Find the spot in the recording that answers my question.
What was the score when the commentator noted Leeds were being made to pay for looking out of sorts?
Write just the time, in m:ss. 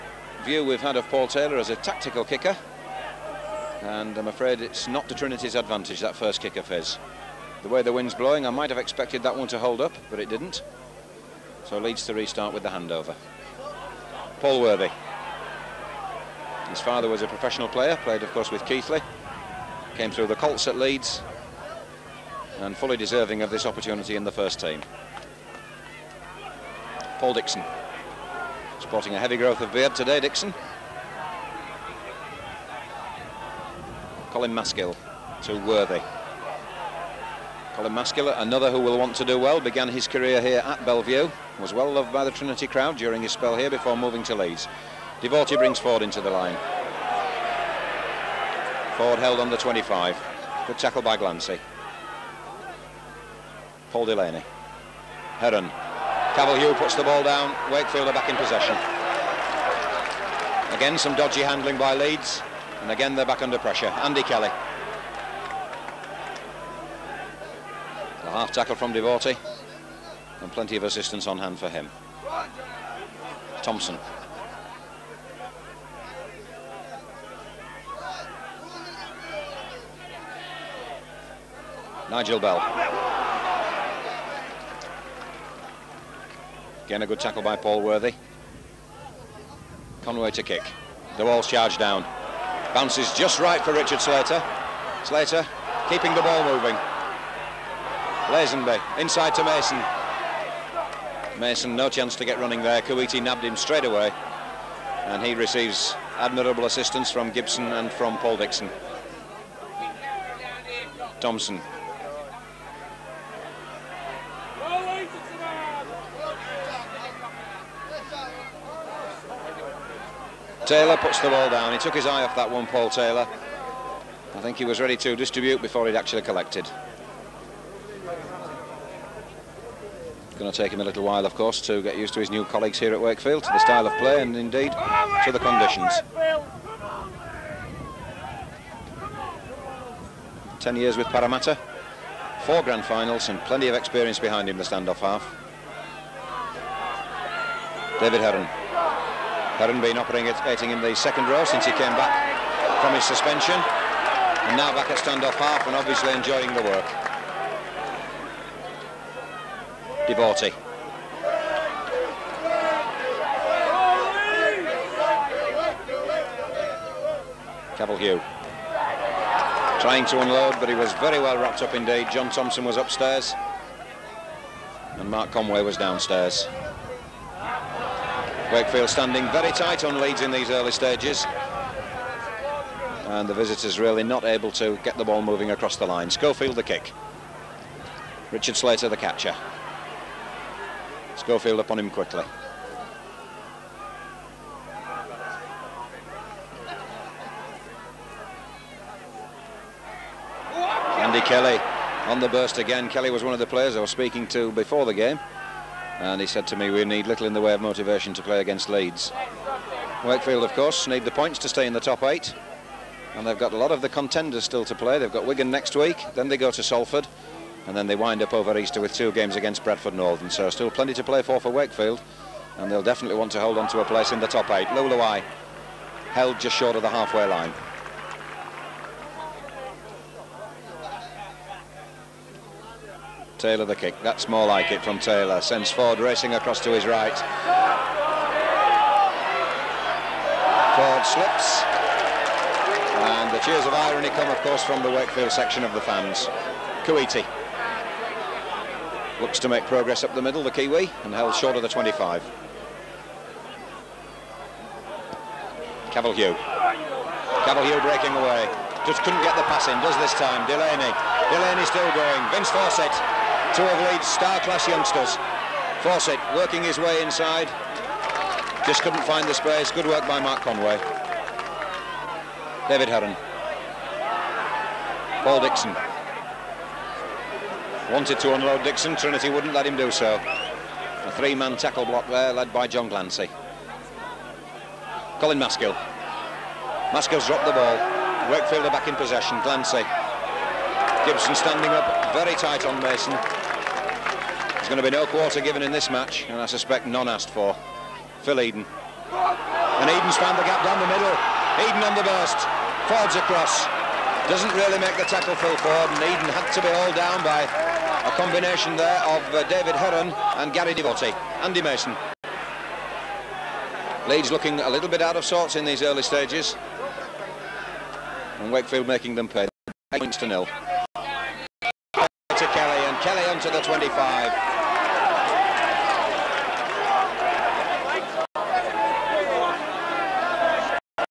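5:19.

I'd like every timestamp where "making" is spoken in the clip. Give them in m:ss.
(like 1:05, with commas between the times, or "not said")
5:18.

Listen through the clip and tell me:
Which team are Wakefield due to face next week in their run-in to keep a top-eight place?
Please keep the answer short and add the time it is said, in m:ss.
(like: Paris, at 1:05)
Wigan, at 3:35.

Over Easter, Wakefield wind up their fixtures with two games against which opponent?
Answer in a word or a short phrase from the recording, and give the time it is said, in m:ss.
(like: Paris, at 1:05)
Bradford Northern, at 3:39.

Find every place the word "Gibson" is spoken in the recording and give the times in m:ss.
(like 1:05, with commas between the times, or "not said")
1:47, 4:51.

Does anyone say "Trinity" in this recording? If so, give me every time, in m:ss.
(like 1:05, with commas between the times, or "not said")
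0:05, 0:42, 4:38.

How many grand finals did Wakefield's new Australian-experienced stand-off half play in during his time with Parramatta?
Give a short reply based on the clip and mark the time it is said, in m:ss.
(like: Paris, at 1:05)
4, at 2:22.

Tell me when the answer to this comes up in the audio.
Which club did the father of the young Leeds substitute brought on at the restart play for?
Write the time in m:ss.
0:18.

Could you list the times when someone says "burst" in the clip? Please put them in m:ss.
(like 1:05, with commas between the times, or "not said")
3:22, 5:02.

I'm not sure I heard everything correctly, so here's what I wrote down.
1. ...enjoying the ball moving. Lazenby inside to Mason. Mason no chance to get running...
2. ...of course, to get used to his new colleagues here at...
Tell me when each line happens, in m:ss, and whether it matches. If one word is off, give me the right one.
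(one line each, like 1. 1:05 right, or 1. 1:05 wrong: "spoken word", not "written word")
1. 1:35 wrong: "keeping", not "enjoying"
2. 2:11 right.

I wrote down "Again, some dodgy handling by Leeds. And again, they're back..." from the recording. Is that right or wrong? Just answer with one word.
right.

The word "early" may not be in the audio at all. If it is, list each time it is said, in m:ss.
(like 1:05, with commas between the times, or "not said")
3:00, 5:15.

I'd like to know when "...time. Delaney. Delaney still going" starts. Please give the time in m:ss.
4:20.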